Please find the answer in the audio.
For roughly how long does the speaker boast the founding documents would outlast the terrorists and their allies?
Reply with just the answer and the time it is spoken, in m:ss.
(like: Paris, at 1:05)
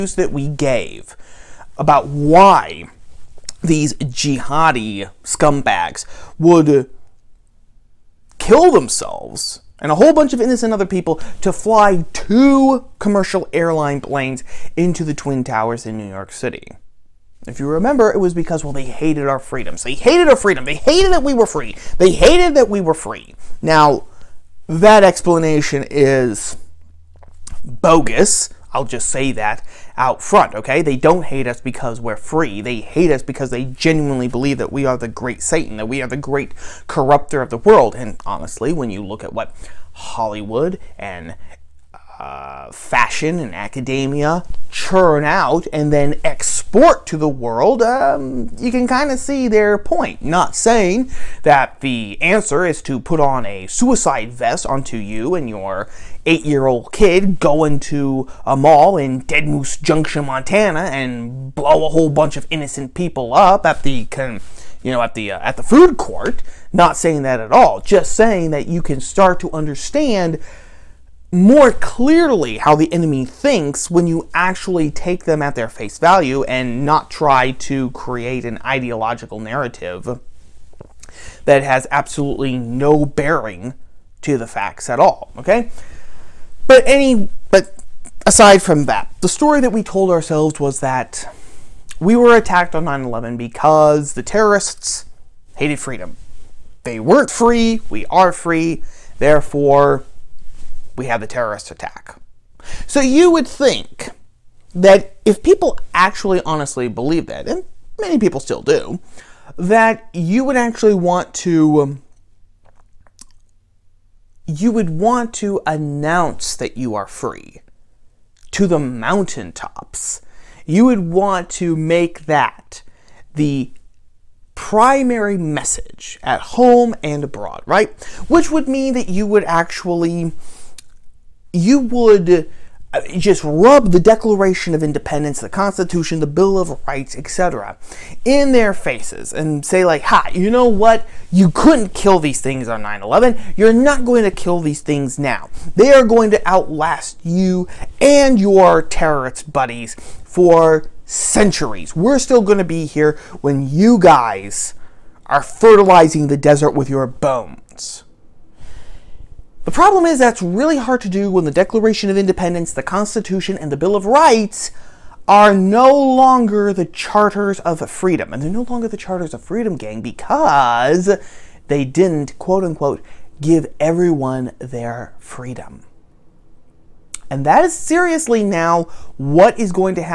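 centuries, at 2:31.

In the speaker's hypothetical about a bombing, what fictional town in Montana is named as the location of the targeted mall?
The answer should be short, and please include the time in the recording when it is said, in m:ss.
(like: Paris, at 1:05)
Dead Moose Junction, at 0:59.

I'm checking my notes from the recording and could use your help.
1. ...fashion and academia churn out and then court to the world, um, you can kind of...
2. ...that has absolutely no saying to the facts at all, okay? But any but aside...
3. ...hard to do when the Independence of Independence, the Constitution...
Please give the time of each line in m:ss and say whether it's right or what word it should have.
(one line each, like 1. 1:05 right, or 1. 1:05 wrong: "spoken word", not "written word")
1. 0:42 wrong: "export", not "court"
2. 1:21 wrong: "bearing", not "saying"
3. 2:40 wrong: "Declaration", not "Independence".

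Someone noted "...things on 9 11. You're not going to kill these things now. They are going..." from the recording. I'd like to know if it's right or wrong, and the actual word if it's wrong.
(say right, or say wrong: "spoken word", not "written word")
right.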